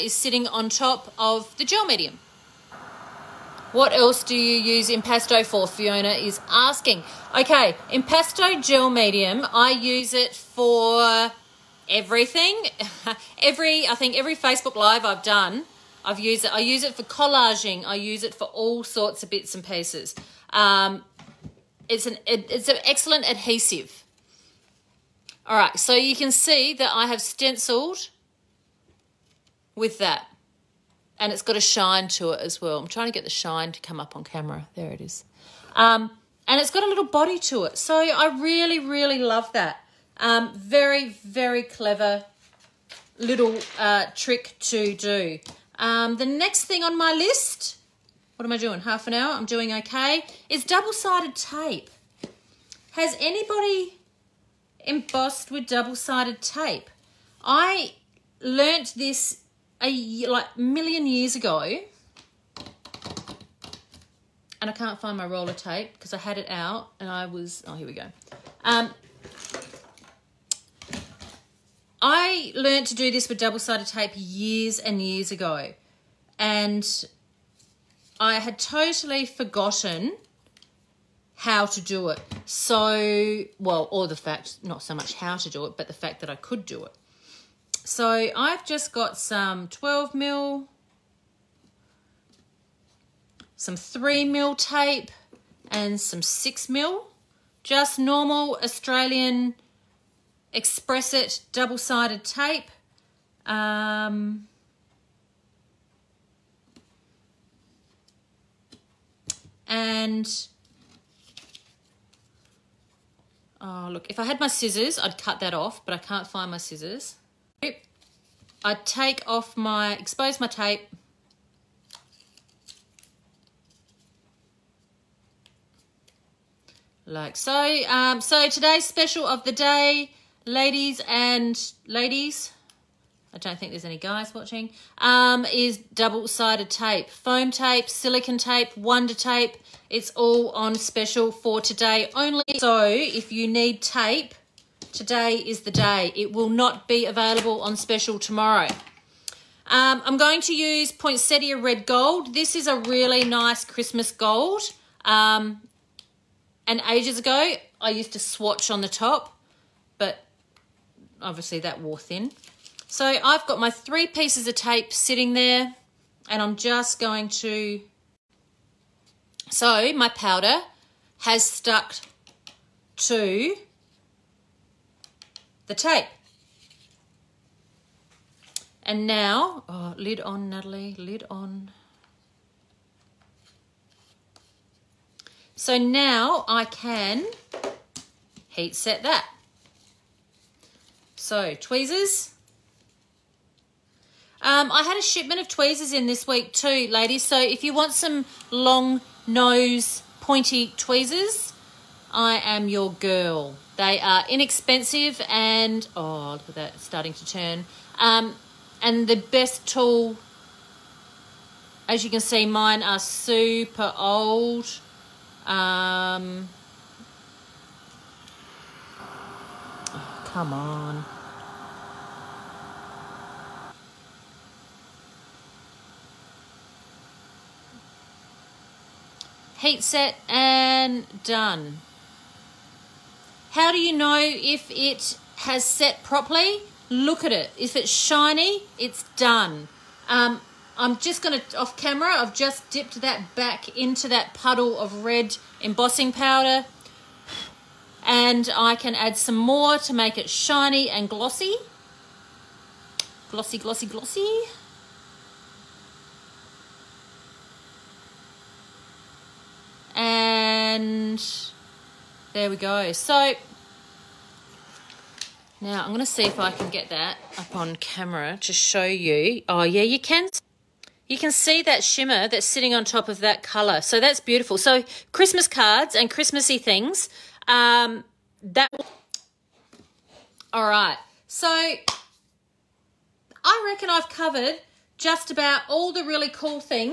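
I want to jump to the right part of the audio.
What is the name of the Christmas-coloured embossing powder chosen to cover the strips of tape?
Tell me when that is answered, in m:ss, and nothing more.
2:30.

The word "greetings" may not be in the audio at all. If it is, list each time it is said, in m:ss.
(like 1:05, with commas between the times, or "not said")
not said.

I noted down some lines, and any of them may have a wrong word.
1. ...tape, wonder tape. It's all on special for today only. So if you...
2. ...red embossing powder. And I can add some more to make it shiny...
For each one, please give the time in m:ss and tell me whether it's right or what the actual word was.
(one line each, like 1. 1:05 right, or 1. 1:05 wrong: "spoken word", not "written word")
1. 2:18 right
2. 4:05 right.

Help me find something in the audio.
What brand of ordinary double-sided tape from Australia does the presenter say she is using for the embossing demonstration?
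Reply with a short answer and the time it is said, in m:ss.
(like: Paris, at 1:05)
Xpress It, at 1:40.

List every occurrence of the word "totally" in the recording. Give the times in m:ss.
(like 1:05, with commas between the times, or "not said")
1:18.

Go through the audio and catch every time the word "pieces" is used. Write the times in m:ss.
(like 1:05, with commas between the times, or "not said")
0:19, 2:44.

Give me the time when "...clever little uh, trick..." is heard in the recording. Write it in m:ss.
0:41.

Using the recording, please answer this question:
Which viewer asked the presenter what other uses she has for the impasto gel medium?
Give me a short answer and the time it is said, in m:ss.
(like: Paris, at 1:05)
Fiona, at 0:05.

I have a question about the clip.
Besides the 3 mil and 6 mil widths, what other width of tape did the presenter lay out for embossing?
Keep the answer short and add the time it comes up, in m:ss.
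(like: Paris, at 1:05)
12 mil, at 1:29.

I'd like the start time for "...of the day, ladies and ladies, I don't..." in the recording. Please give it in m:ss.
2:09.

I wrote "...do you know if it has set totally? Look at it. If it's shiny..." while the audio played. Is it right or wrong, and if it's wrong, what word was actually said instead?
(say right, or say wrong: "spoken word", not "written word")
wrong: "properly", not "totally".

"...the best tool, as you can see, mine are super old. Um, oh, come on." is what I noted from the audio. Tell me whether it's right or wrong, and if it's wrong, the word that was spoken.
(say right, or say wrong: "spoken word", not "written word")
right.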